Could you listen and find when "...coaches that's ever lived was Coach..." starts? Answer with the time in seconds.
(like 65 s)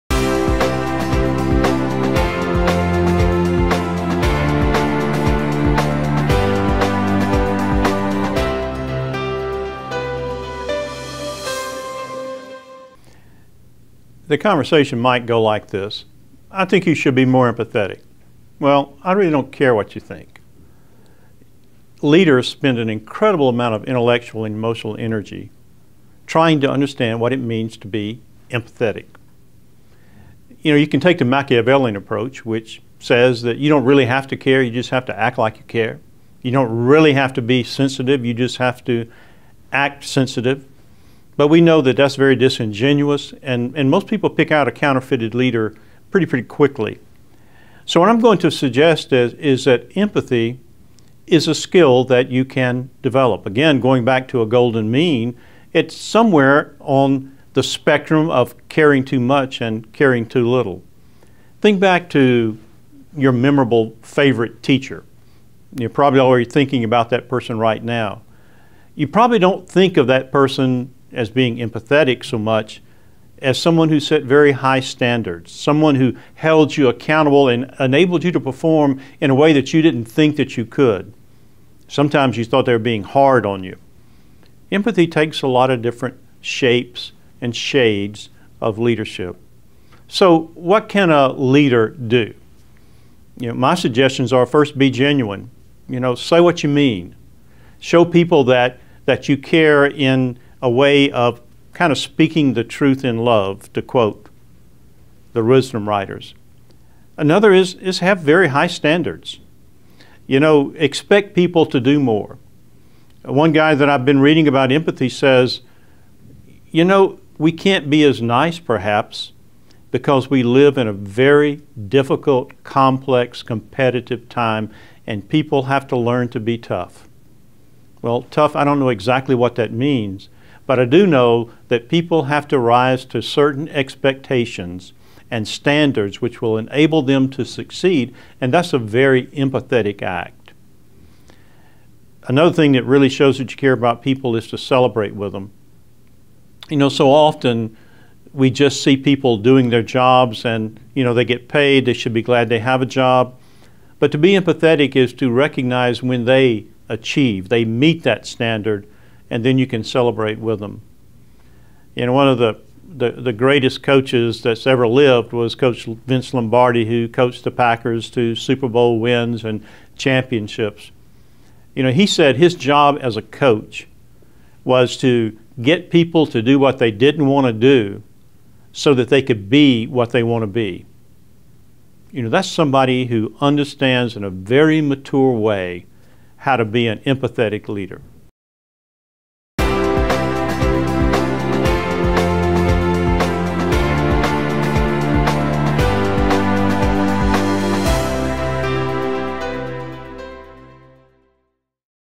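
163 s.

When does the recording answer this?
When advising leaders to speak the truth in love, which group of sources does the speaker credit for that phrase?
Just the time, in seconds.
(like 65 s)
105 s.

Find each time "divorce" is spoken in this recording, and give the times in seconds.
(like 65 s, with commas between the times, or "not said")
not said.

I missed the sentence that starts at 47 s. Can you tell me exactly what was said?
So, what I'm going to suggest is, is that empathy is a skill that you can develop.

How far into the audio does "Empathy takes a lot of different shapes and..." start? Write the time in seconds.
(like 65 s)
84 s.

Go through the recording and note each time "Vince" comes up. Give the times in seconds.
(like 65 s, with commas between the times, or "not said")
165 s.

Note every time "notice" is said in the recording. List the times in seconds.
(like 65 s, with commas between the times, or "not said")
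not said.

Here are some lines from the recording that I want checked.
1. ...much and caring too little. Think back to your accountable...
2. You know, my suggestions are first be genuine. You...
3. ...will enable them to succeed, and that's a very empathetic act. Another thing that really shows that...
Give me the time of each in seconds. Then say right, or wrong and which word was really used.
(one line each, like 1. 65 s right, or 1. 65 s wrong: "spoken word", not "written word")
1. 59 s wrong: "memorable", not "accountable"
2. 93 s right
3. 136 s right.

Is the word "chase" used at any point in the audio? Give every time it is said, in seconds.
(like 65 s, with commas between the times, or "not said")
not said.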